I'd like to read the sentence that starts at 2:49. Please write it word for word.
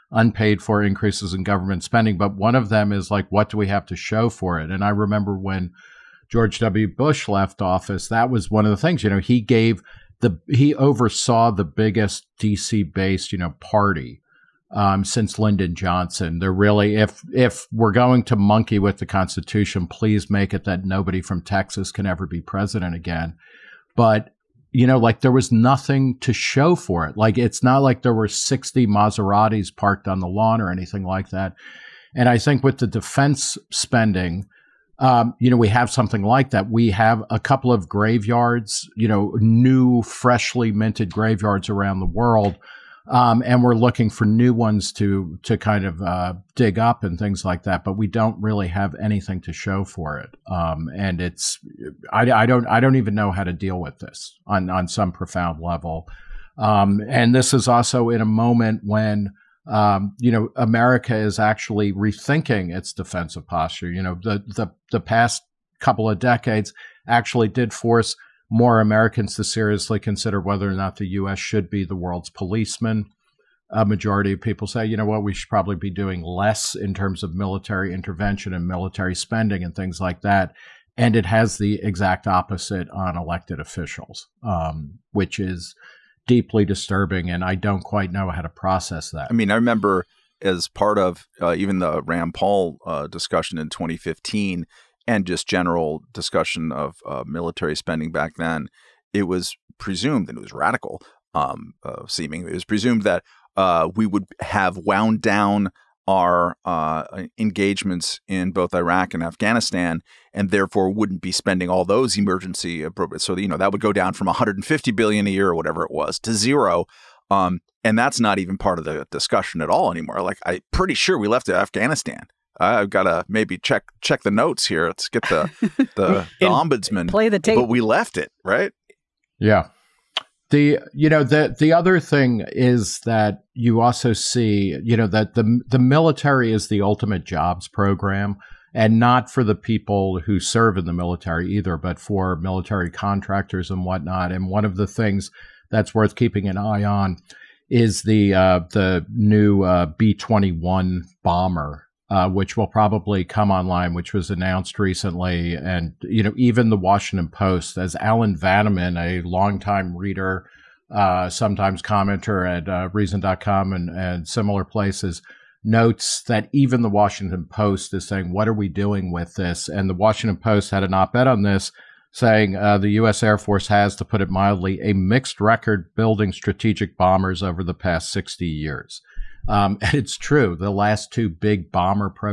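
And the Washington Post had an op ed on this saying uh, the U.S.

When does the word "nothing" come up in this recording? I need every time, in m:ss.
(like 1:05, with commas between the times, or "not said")
0:25.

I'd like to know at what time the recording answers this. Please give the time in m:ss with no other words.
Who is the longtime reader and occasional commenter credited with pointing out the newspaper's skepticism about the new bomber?
2:37.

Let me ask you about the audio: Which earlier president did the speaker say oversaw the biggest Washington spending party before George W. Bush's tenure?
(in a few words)
Lyndon Johnson.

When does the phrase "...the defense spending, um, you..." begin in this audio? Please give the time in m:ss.
0:32.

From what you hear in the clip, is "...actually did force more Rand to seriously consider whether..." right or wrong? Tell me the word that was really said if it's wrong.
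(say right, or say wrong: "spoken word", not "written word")
wrong: "Americans", not "Rand".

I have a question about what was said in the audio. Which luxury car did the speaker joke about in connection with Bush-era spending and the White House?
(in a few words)
Maseratis.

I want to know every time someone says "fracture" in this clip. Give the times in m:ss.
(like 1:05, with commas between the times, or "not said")
not said.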